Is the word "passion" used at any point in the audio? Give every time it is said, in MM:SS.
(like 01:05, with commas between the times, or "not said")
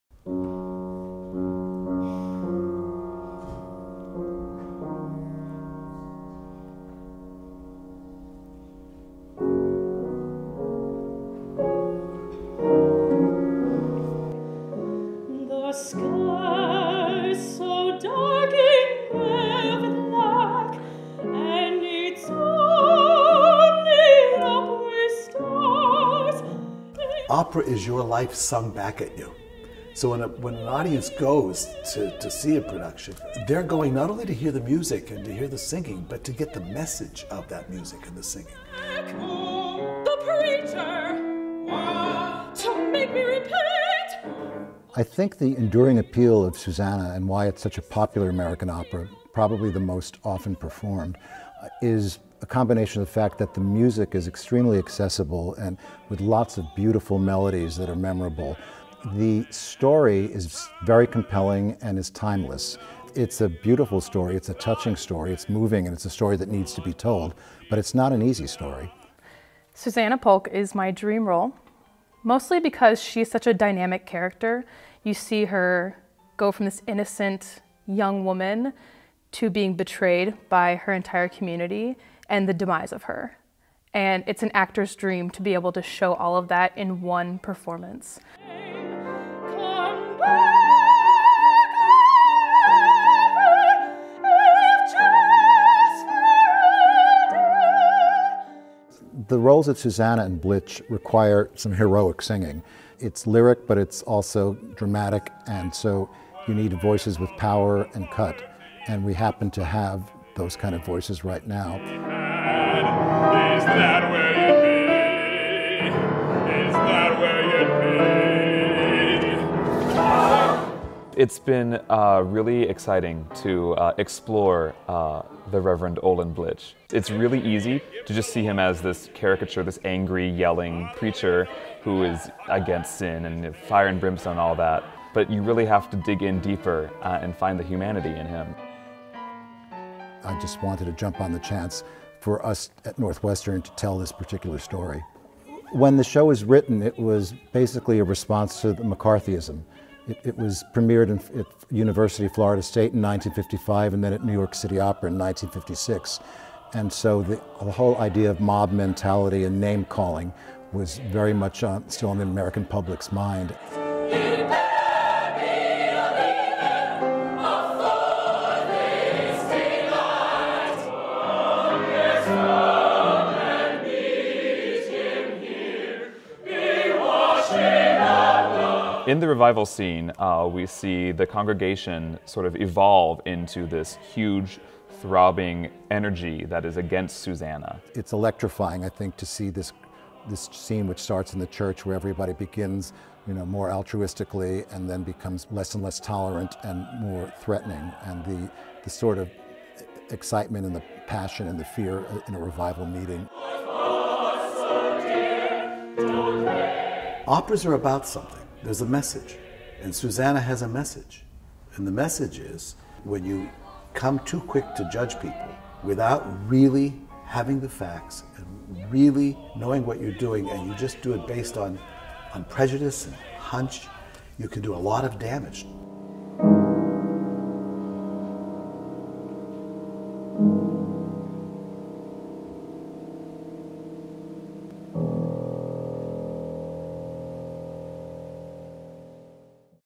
03:21.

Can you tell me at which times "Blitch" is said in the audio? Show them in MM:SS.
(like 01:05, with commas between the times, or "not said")
01:40, 02:06.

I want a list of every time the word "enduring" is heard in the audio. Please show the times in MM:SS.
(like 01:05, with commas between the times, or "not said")
00:45.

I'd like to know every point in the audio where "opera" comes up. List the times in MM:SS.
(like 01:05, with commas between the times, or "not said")
00:48, 02:34, 03:27.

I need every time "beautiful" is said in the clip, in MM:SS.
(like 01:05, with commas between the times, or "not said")
00:56, 01:03.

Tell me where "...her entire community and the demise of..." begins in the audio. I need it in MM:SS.
01:20.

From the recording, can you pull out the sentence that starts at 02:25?
When the show was written, it was basically a response to the McCarthyism.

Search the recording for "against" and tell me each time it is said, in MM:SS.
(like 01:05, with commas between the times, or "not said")
02:12, 03:06.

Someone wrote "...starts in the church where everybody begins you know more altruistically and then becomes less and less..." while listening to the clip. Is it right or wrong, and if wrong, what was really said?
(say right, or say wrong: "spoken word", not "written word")
right.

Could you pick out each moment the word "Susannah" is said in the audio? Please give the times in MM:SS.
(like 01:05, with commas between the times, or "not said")
00:46, 01:09, 01:39, 03:07, 03:29.